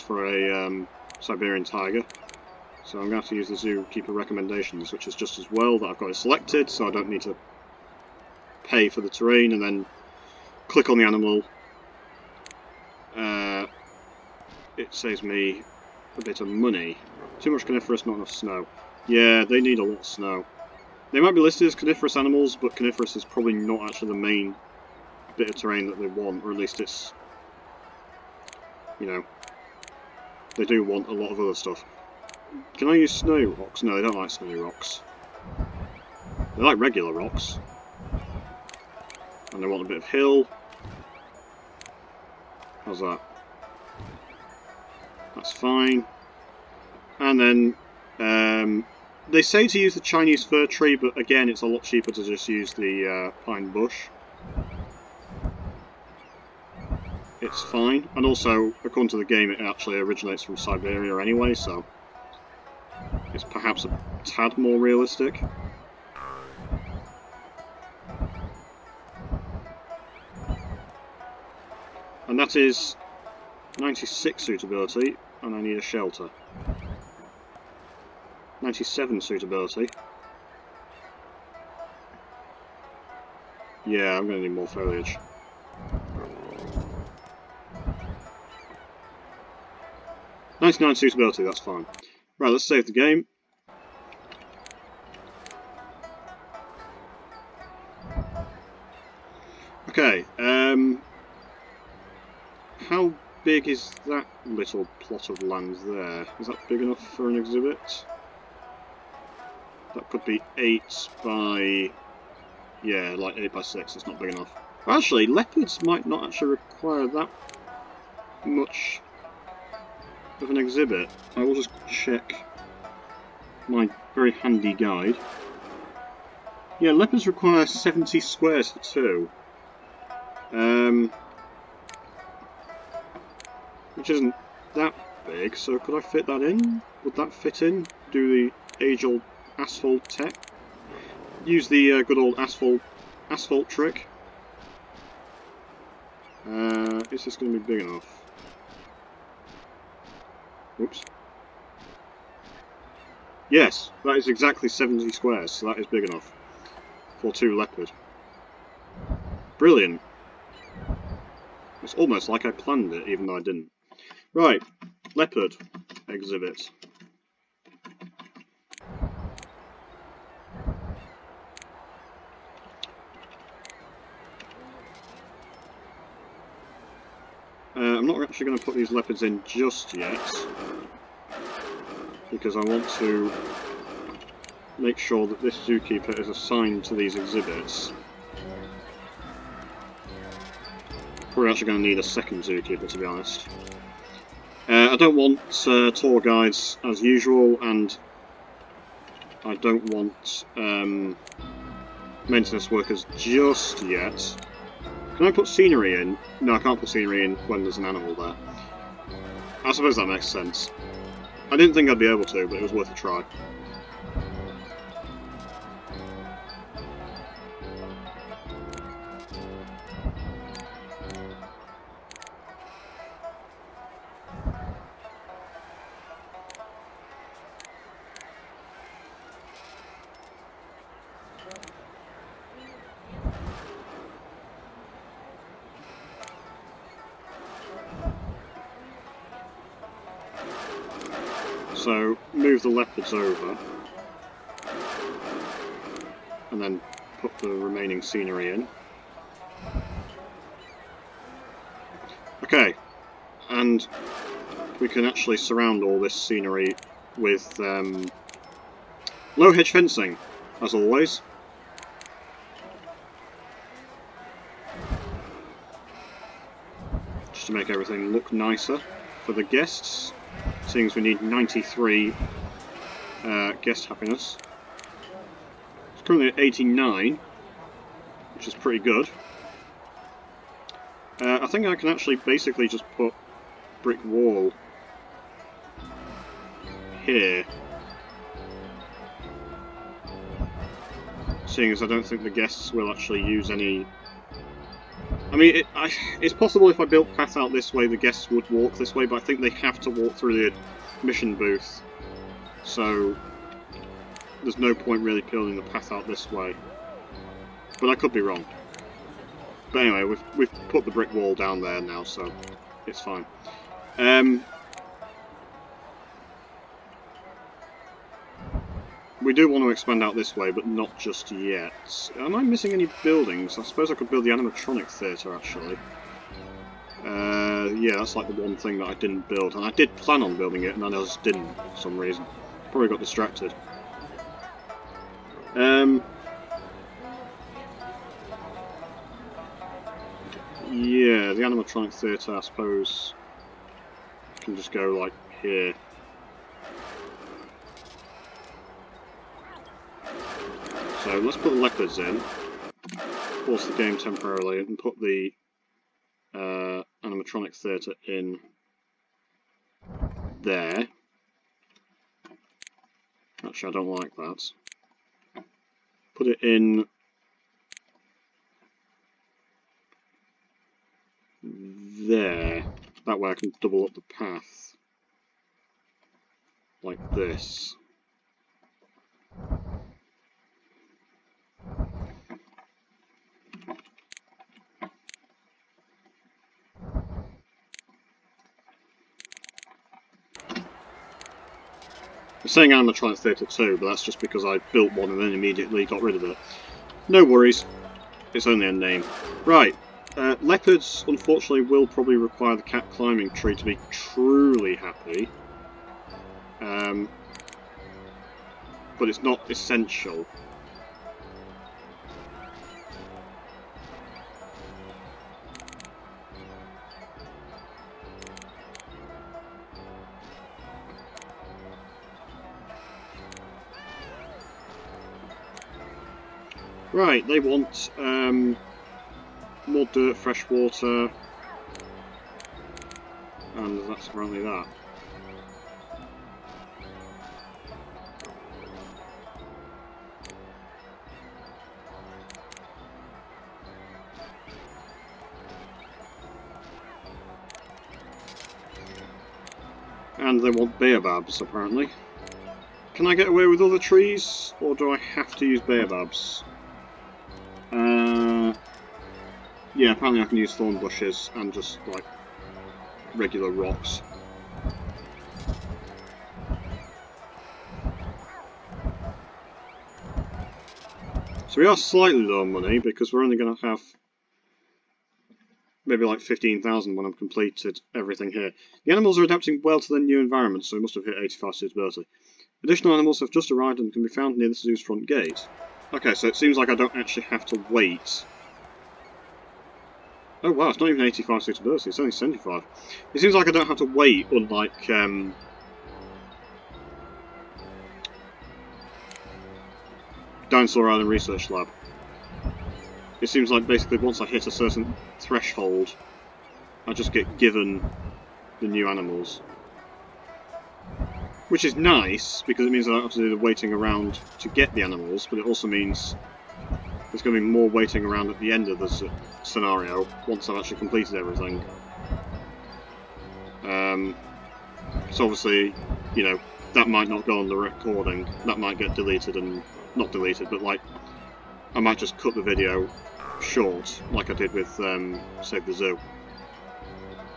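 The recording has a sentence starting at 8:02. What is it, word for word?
Additional animals have just arrived and can be found near the zoo's front gate.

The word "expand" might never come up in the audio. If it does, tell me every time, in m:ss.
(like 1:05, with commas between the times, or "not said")
5:19.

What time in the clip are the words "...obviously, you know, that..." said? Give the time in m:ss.
8:45.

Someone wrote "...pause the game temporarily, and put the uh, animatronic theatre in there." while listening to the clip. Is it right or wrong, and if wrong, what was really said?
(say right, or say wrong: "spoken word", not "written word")
right.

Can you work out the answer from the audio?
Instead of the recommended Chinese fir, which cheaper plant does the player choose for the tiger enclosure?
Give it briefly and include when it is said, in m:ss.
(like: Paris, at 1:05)
pine bush, at 0:53.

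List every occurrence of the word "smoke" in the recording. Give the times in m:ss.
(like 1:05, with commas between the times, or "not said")
not said.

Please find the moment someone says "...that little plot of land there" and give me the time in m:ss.
1:44.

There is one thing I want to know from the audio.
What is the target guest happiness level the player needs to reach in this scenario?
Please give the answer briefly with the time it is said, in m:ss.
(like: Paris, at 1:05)
93, at 4:31.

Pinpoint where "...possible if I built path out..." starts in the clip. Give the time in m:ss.
4:56.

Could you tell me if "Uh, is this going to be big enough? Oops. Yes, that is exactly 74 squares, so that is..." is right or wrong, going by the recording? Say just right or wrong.
wrong.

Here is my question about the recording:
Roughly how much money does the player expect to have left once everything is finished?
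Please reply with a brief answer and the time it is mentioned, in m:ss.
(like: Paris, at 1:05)
15,000, at 7:56.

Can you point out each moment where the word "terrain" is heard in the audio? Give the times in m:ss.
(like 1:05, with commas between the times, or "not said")
0:09, 0:25.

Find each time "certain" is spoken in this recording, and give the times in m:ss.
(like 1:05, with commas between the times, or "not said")
8:24.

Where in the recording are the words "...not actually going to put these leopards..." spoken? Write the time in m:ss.
2:58.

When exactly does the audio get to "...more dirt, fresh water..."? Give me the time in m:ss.
7:09.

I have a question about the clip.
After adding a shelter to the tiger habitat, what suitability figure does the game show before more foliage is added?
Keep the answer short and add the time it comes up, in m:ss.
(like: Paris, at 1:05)
97, at 1:18.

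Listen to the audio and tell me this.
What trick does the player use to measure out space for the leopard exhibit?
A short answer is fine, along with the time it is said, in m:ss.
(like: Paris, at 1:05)
asphalt trick, at 2:23.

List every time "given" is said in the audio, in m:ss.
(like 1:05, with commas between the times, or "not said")
8:27.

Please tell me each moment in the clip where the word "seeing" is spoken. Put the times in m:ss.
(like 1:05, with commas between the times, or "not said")
4:30, 4:51.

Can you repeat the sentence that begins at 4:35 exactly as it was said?
It's currently at 89 which is pretty good.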